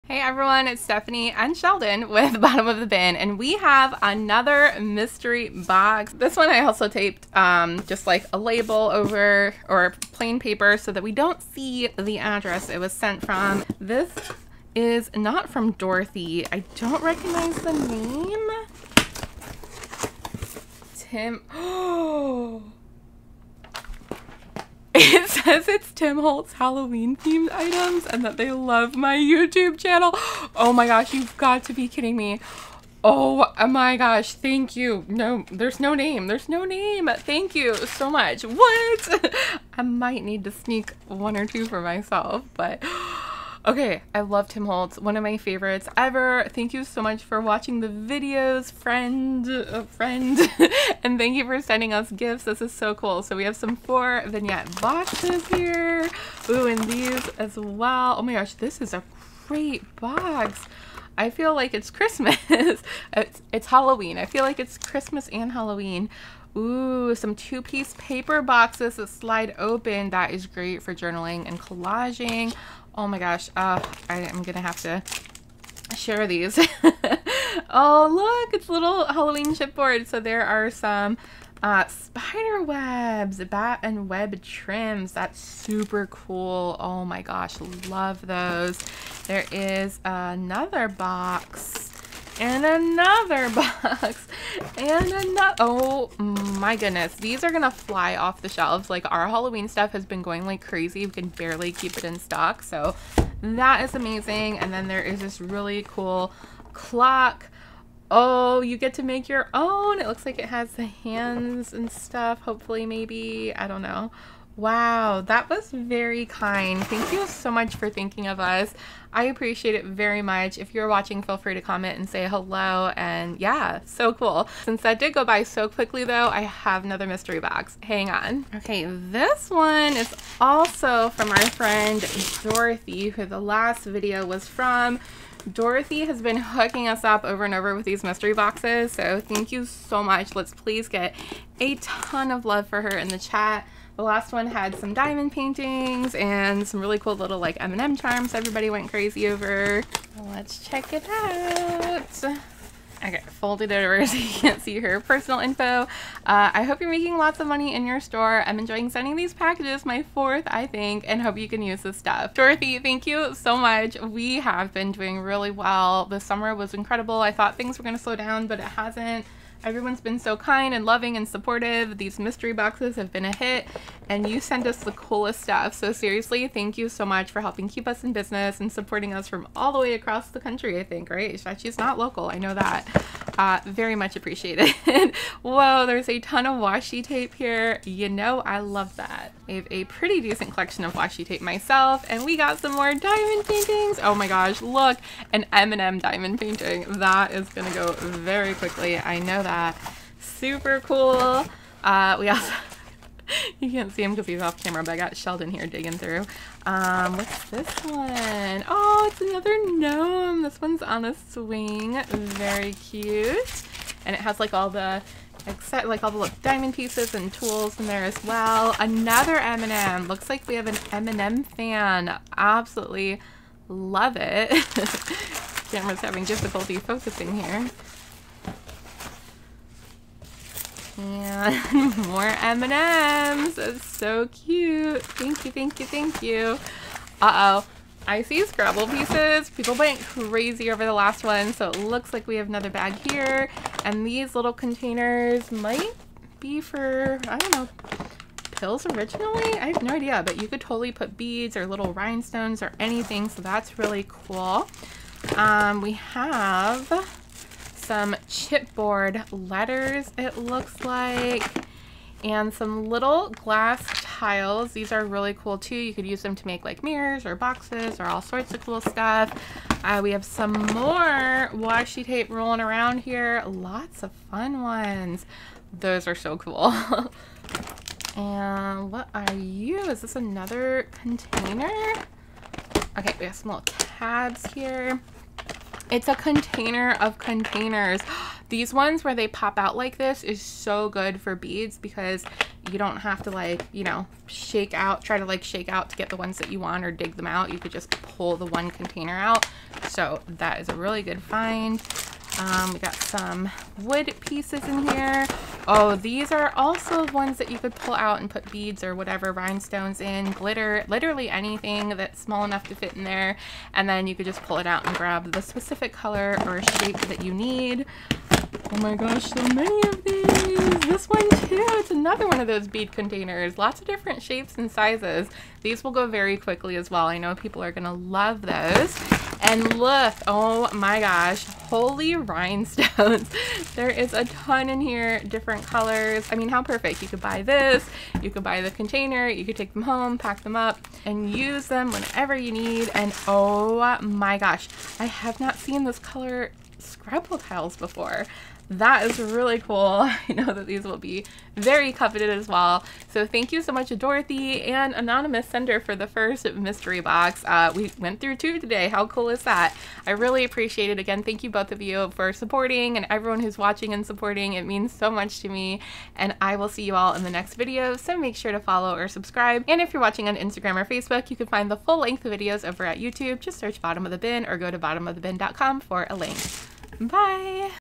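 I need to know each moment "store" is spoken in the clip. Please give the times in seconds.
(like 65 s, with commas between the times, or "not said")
157 s.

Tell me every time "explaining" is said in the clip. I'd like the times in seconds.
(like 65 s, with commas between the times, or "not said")
not said.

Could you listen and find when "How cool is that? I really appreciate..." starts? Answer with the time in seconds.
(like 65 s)
358 s.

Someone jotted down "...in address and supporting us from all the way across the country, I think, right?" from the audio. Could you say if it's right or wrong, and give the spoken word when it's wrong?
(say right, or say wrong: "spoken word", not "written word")
wrong: "business", not "address".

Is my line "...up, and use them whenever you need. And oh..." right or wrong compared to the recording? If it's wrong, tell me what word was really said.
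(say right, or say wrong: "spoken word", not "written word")
right.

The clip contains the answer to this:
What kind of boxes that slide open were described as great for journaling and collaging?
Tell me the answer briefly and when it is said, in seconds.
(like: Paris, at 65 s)
Two-piece paper boxes, at 67 s.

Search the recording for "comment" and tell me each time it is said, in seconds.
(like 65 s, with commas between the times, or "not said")
121 s.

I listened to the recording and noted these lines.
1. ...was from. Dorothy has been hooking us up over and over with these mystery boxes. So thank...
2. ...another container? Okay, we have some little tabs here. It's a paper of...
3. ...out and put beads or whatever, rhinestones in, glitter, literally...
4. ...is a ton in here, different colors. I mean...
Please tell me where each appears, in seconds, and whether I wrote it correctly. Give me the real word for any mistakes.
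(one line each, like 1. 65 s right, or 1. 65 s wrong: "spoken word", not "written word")
1. 134 s right
2. 280 s wrong: "container", not "paper"
3. 307 s right
4. 333 s right.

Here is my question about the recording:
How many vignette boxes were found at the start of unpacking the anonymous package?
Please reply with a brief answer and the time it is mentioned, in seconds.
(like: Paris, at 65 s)
4, at 53 s.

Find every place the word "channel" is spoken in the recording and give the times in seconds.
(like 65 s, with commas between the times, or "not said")
29 s.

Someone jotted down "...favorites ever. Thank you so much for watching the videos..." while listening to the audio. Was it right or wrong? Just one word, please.
right.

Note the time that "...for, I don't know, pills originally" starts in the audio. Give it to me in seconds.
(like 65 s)
246 s.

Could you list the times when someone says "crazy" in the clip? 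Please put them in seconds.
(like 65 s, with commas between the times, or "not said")
100 s, 148 s, 240 s.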